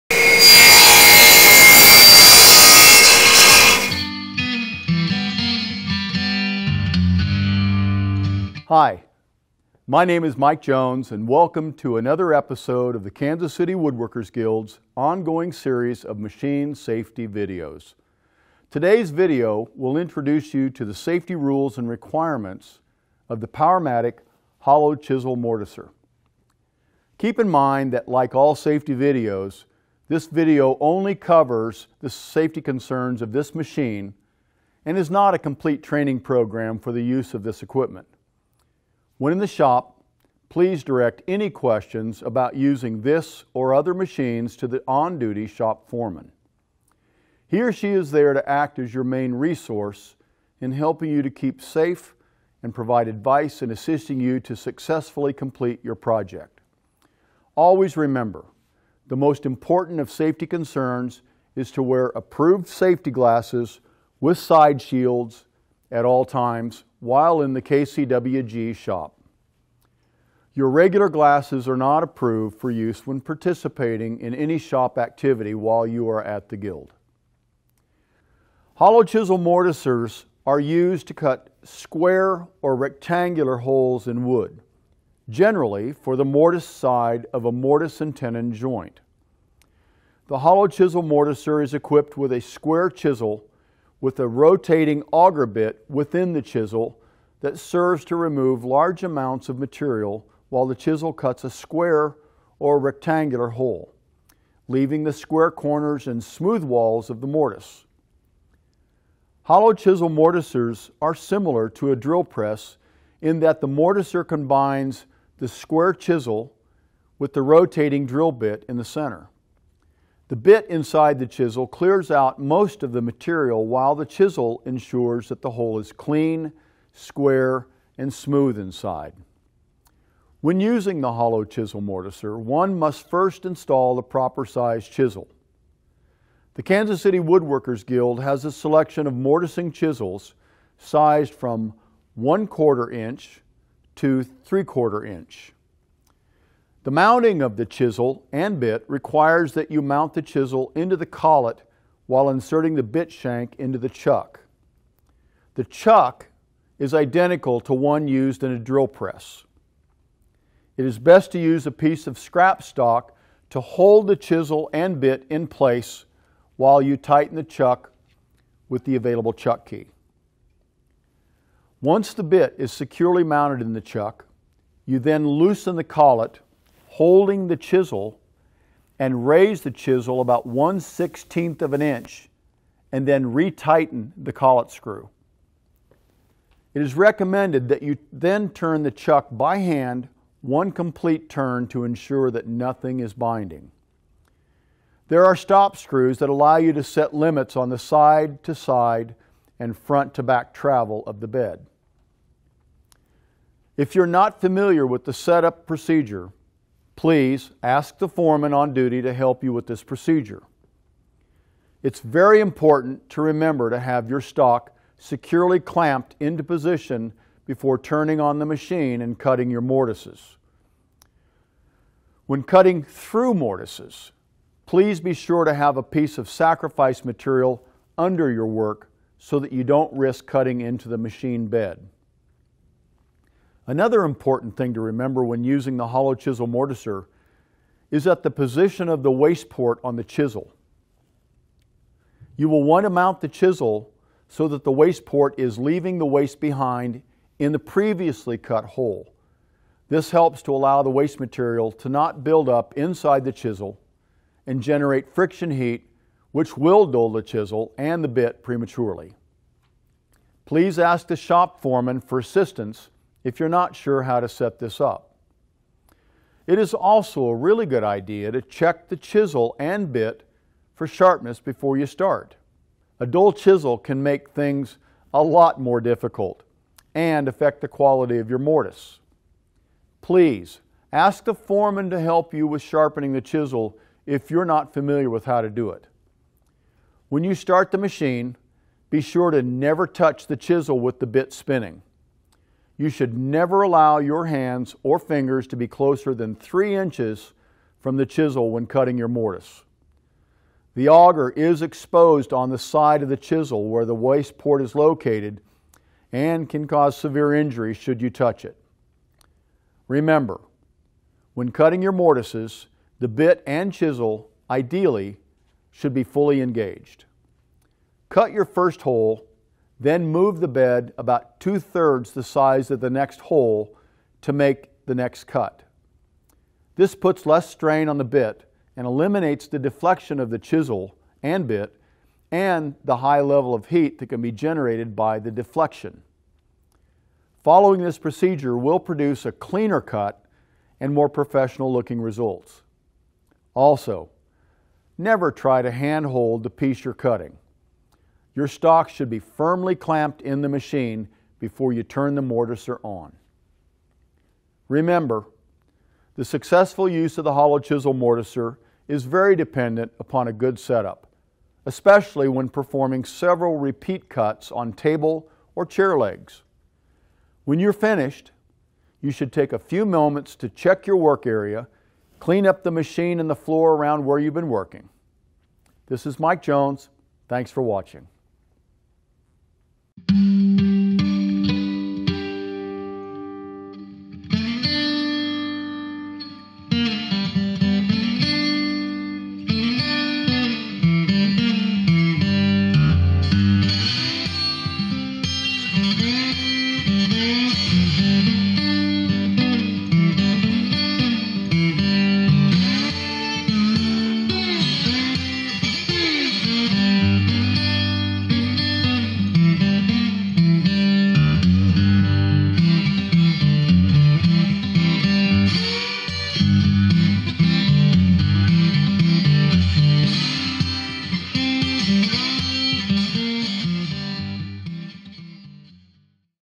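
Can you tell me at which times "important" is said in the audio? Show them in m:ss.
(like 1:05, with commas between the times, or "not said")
0:59, 3:32, 3:54.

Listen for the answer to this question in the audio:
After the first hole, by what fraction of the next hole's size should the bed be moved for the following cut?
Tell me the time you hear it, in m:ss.
5:21.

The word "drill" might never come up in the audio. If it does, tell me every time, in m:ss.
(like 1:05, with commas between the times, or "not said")
1:51, 1:58, 2:38.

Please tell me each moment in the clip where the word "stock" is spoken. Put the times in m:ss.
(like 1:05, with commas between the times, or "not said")
2:42, 3:34, 5:48.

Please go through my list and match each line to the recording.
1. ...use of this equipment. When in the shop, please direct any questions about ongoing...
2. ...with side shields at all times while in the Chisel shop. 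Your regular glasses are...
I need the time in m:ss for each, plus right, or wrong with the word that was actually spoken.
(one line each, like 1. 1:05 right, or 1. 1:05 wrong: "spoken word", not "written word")
1. 0:37 wrong: "using", not "ongoing"
2. 1:04 wrong: "KCWG", not "Chisel".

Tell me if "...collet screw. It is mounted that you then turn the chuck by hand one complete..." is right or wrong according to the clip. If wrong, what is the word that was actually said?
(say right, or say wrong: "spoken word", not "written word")
wrong: "recommended", not "mounted".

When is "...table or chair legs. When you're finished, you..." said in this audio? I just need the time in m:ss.
6:04.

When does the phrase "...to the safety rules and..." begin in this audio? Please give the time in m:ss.
0:20.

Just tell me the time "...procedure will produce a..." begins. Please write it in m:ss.
5:37.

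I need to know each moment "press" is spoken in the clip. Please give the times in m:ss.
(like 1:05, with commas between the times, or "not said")
1:52, 2:38.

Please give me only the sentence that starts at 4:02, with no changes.
You will want to mount the chisel so that the waste port is leaving the waste behind in the previously cut hole.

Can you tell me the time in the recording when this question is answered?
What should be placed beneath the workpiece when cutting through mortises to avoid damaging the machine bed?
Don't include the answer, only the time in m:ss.
3:46.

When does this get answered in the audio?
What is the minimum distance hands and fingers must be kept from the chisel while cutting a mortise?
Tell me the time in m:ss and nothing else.
4:56.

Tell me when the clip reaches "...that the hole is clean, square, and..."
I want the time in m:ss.
2:05.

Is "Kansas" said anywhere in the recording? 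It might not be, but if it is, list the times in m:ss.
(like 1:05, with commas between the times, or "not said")
0:13, 2:16.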